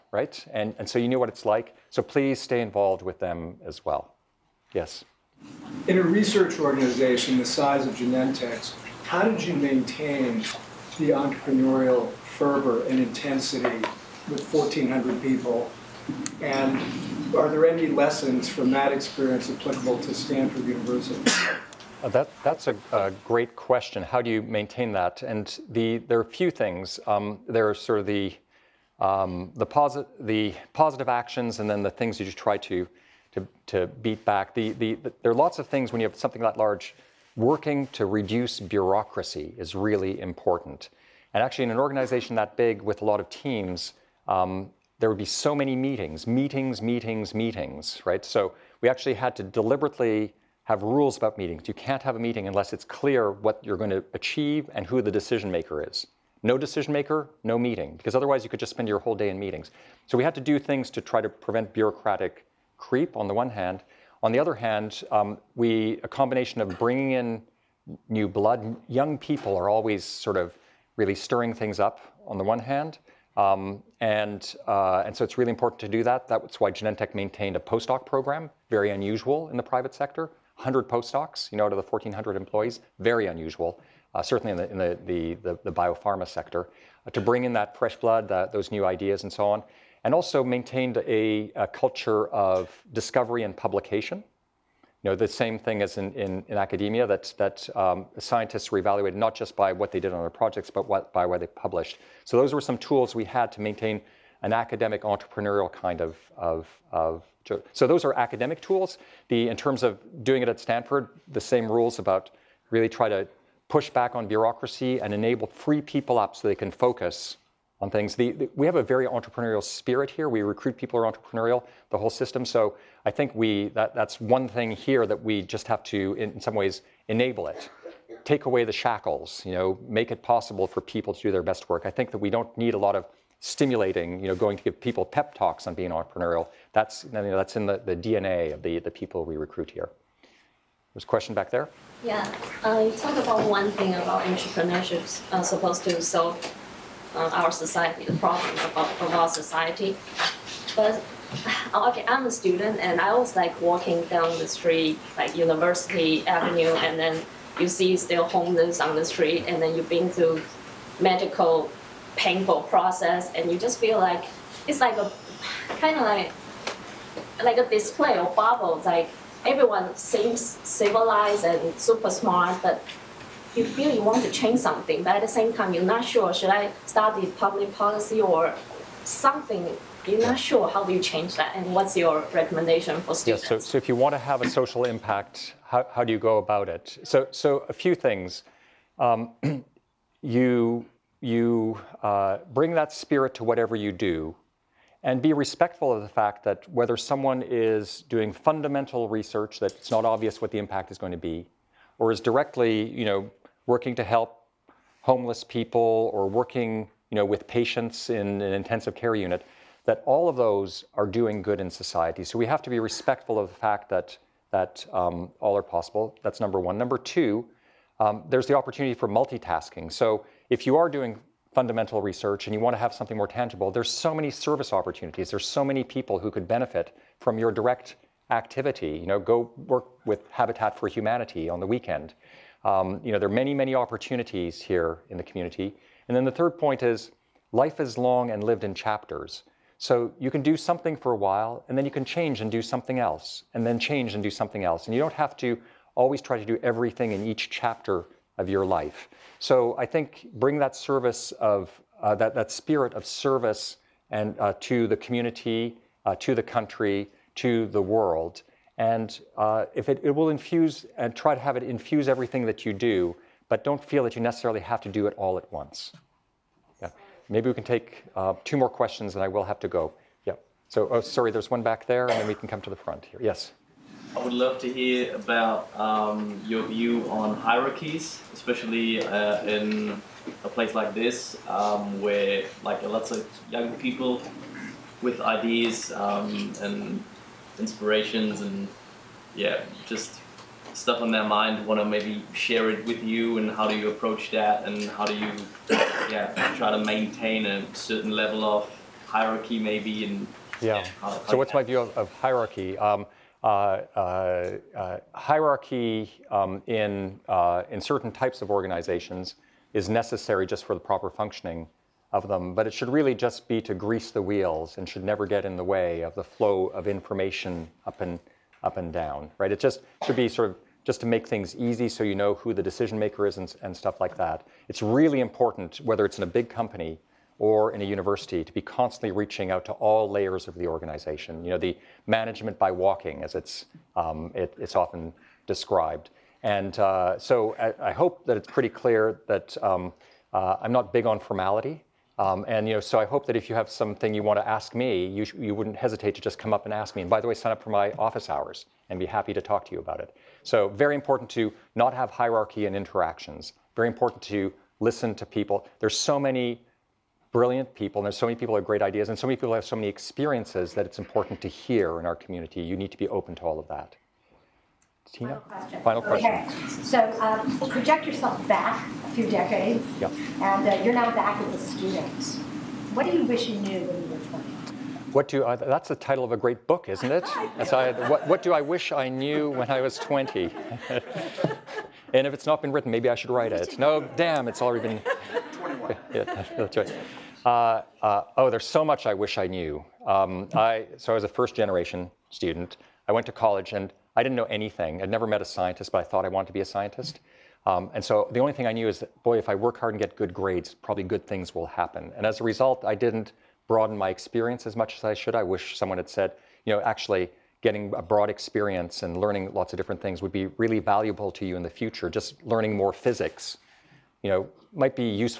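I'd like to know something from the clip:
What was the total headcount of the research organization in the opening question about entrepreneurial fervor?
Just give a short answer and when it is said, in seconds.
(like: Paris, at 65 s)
1,400, at 14 s.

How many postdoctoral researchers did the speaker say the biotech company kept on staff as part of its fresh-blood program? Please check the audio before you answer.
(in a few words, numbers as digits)
100.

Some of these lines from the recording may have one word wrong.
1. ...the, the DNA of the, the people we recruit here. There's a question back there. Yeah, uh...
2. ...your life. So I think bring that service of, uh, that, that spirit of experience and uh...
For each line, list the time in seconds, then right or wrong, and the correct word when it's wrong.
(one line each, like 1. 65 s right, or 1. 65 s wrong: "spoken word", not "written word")
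1. 137 s right
2. 248 s wrong: "service", not "experience".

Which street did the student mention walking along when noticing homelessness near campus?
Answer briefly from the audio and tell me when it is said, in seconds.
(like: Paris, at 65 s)
University Avenue, at 155 s.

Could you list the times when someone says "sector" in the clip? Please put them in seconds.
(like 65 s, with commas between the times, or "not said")
79 s, 86 s.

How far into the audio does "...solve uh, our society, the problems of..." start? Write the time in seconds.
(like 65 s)
146 s.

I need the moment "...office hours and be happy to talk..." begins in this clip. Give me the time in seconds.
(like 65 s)
347 s.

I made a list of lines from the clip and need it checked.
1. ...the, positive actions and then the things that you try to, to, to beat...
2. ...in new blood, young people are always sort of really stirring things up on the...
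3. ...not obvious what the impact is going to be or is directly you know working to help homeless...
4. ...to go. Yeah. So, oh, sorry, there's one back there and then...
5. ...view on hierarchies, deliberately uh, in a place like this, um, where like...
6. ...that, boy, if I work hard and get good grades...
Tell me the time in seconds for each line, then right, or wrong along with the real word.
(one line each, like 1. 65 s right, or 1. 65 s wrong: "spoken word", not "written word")
1. 30 s right
2. 67 s right
3. 199 s right
4. 269 s right
5. 276 s wrong: "especially", not "deliberately"
6. 398 s right.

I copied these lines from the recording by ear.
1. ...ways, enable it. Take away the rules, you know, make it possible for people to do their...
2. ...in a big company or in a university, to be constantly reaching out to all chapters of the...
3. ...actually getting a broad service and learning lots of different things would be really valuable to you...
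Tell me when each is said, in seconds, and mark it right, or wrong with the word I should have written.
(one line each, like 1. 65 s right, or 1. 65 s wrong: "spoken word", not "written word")
1. 126 s wrong: "shackles", not "rules"
2. 326 s wrong: "layers", not "chapters"
3. 406 s wrong: "experience", not "service".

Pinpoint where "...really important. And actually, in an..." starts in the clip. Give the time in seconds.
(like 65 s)
39 s.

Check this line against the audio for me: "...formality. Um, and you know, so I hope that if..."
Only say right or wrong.
right.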